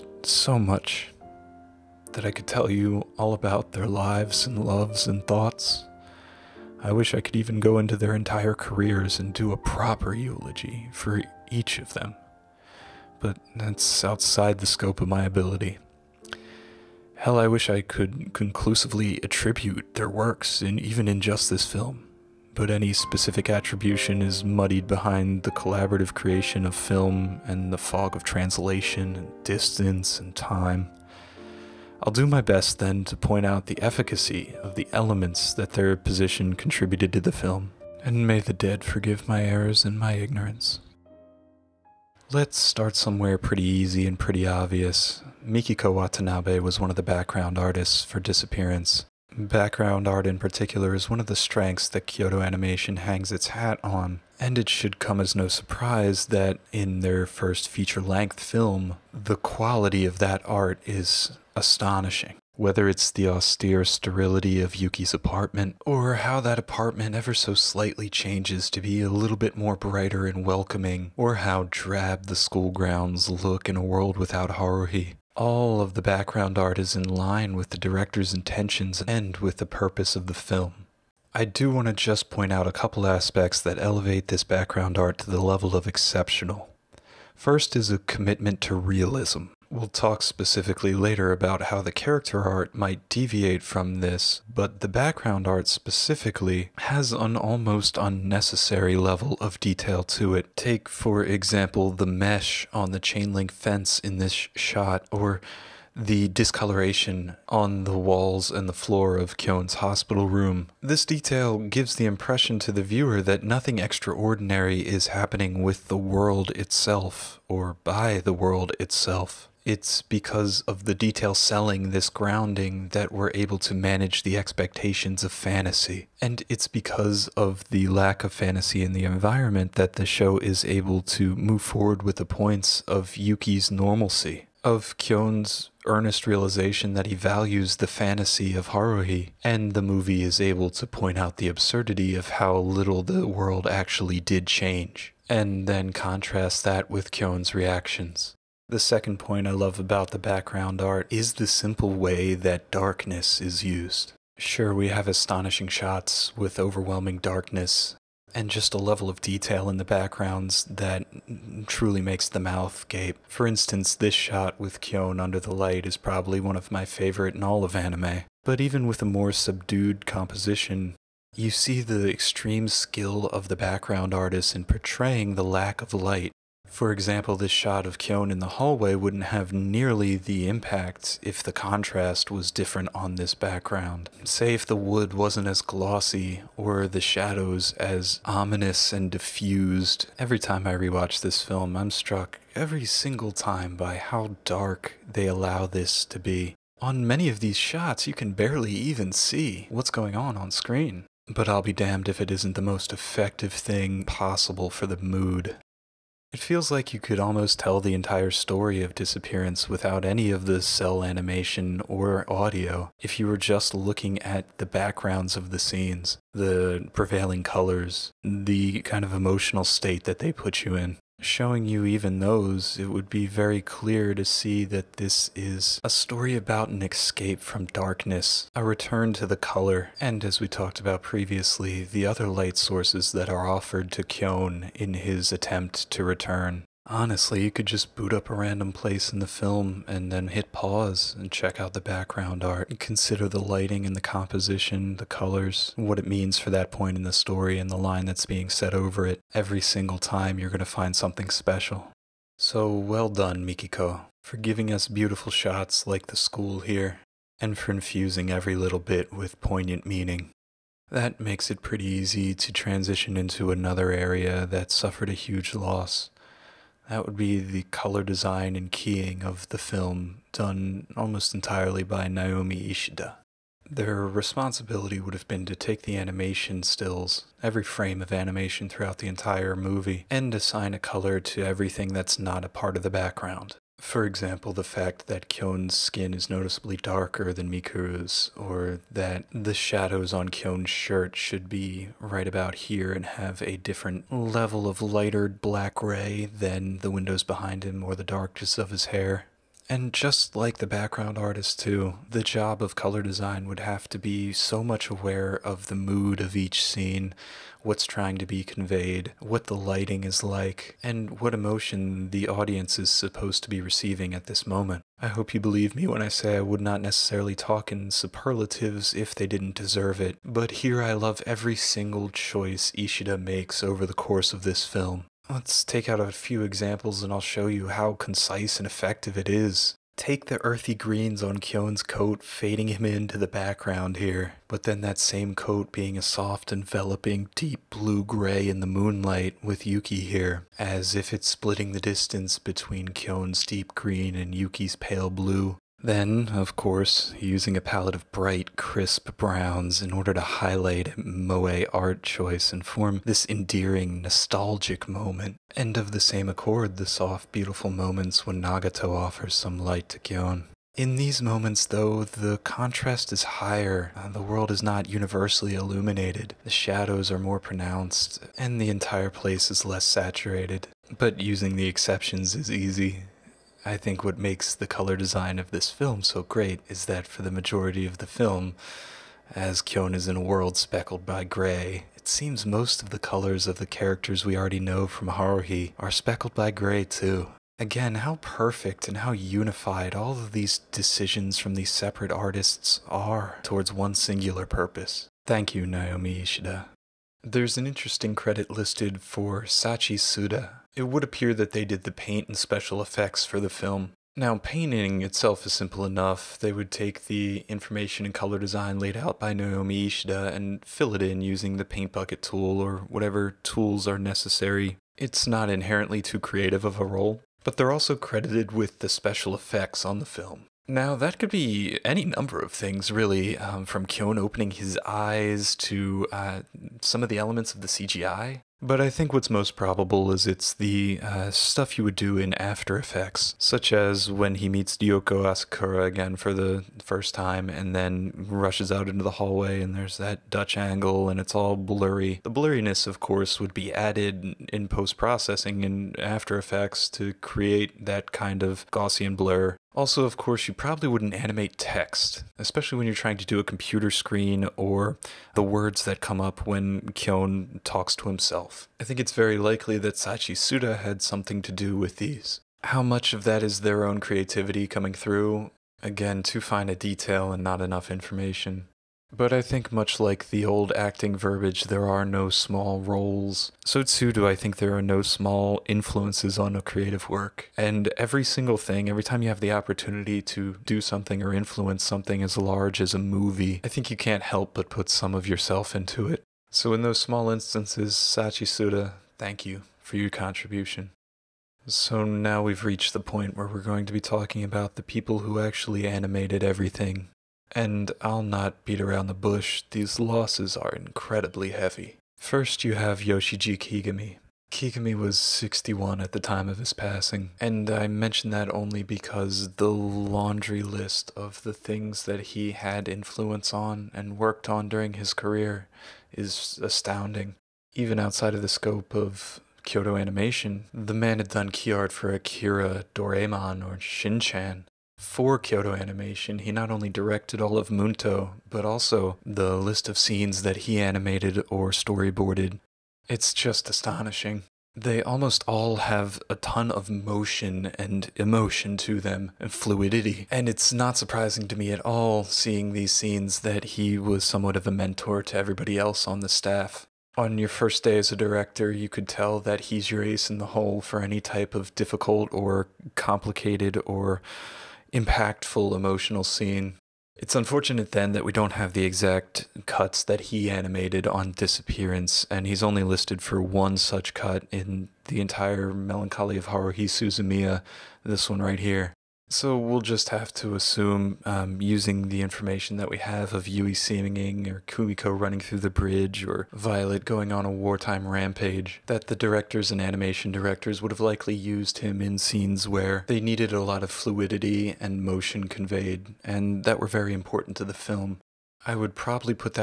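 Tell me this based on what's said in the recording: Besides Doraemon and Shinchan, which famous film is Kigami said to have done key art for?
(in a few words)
Akira.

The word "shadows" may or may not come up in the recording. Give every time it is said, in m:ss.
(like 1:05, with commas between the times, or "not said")
3:06, 4:49, 6:06.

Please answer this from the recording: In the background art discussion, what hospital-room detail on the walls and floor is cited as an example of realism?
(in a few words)
discoloration.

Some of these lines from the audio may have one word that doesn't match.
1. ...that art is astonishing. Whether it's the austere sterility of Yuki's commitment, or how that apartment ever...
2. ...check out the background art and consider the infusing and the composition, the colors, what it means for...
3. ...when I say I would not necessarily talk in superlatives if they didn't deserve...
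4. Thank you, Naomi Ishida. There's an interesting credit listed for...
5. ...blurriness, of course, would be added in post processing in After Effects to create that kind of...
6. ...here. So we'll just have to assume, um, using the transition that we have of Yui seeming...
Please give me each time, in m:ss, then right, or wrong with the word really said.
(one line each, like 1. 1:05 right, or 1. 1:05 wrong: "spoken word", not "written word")
1. 1:00 wrong: "apartment", not "commitment"
2. 4:01 wrong: "lighting", not "infusing"
3. 5:15 right
4. 6:35 right
5. 7:22 right
6. 9:28 wrong: "information", not "transition".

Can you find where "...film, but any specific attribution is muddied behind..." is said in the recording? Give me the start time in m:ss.
0:21.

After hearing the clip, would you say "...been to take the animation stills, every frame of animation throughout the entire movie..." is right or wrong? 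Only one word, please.
right.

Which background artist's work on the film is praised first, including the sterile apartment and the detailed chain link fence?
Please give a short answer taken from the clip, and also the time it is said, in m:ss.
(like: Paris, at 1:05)
Mikiko Watanabe, at 0:45.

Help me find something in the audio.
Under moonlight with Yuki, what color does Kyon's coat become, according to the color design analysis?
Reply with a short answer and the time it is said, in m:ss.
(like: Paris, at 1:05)
deep blue gray, at 5:37.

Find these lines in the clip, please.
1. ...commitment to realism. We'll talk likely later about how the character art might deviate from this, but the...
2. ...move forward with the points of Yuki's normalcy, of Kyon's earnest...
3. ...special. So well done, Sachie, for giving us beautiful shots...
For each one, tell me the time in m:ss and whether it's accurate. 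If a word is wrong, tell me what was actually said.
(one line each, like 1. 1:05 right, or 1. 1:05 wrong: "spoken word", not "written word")
1. 1:27 wrong: "specifically", not "likely"
2. 2:11 right
3. 4:11 wrong: "Mikiko", not "Sachie".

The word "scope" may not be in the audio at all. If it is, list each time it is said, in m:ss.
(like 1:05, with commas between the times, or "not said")
0:14, 8:38.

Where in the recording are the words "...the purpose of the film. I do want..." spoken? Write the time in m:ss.
1:19.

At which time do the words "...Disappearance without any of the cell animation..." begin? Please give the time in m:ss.
3:28.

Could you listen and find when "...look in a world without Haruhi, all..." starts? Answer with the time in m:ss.
1:13.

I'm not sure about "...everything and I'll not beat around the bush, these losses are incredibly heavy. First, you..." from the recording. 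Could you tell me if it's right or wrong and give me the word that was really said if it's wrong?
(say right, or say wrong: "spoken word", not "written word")
right.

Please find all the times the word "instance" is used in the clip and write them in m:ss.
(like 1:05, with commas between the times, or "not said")
2:43, 8:07.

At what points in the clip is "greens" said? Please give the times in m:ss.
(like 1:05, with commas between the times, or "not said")
5:30, 5:43.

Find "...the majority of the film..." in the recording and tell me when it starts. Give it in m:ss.
6:17.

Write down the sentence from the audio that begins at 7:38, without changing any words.
I think it's very likely that Sachie Tsuda had something to do with these.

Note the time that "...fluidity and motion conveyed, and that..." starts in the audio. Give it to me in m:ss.
9:43.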